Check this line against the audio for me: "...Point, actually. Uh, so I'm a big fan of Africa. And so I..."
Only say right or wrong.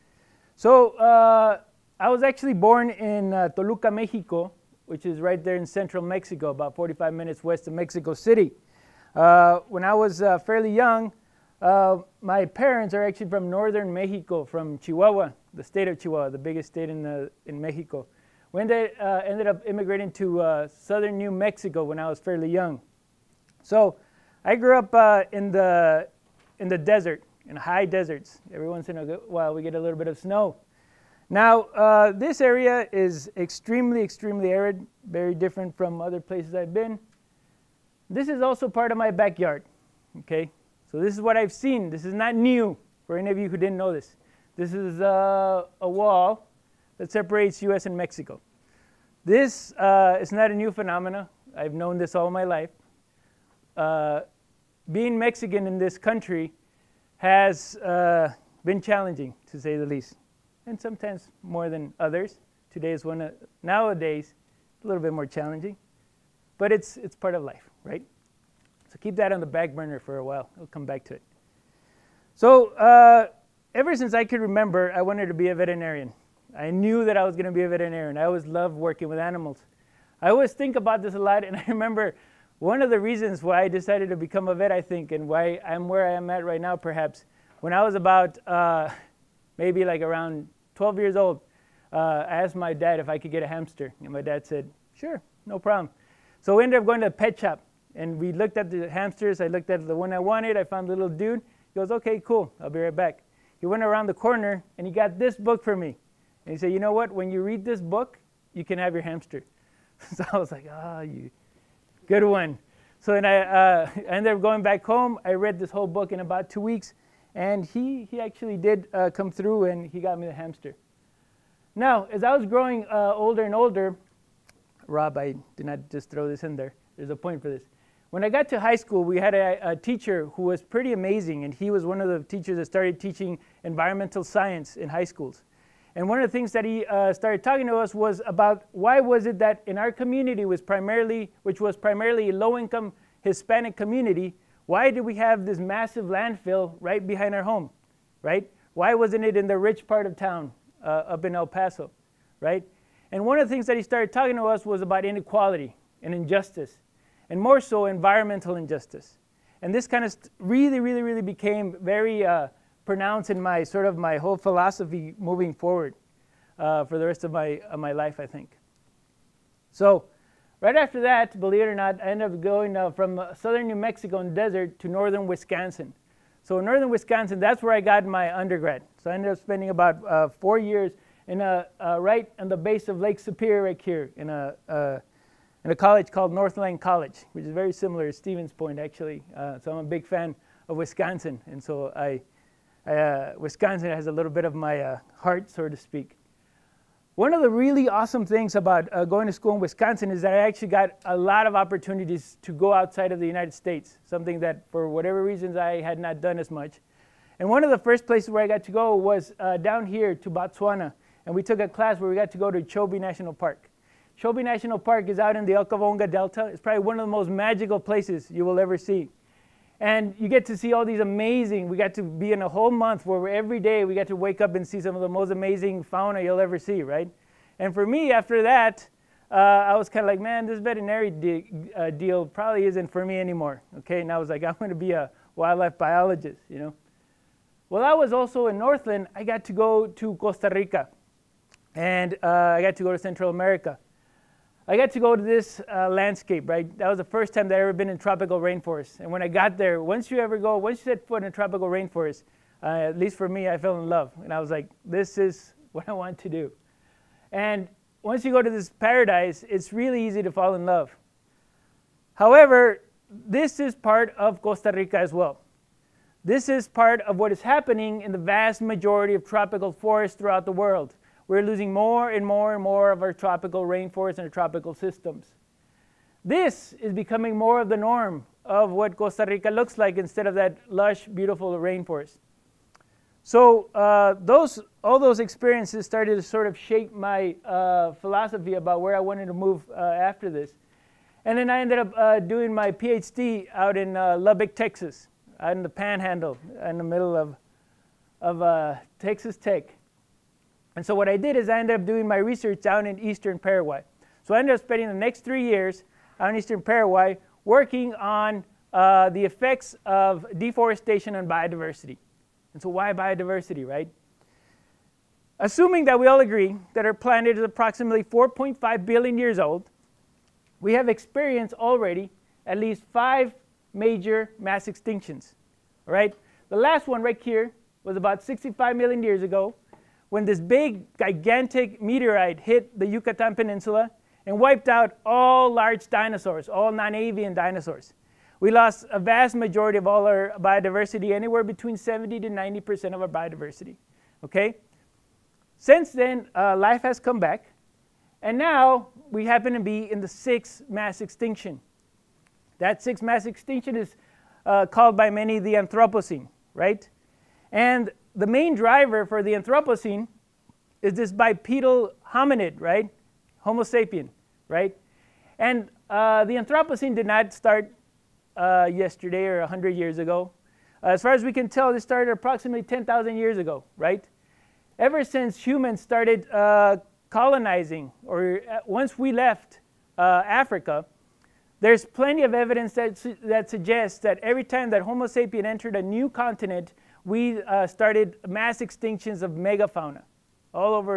wrong.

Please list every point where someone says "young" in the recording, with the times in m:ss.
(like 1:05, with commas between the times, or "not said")
0:10, 0:22.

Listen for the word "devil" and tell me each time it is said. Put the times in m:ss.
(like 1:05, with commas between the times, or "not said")
not said.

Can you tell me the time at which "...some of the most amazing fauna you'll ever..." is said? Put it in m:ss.
3:44.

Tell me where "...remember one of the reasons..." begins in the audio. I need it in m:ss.
1:21.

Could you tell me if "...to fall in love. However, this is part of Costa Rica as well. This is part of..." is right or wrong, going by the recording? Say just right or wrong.
right.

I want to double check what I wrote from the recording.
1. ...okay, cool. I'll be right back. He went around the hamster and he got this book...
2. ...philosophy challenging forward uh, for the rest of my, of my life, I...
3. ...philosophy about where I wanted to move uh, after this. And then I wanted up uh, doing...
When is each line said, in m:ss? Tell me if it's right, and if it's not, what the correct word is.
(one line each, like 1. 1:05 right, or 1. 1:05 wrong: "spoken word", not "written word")
1. 1:41 wrong: "corner", not "hamster"
2. 2:44 wrong: "moving", not "challenging"
3. 4:47 wrong: "ended", not "wanted".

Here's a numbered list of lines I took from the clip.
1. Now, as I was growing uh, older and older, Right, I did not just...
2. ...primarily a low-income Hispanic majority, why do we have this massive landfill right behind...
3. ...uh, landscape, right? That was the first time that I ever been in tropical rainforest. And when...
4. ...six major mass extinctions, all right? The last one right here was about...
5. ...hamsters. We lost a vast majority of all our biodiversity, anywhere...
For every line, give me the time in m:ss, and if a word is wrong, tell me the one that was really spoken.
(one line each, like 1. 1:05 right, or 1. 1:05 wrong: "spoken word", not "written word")
1. 2:01 wrong: "Rob", not "Right"
2. 2:21 wrong: "community", not "majority"
3. 4:05 right
4. 5:22 wrong: "five", not "six"
5. 5:37 wrong: "dinosaurs", not "hamsters".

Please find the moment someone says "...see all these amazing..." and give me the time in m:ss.
3:40.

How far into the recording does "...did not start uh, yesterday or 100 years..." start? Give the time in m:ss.
6:06.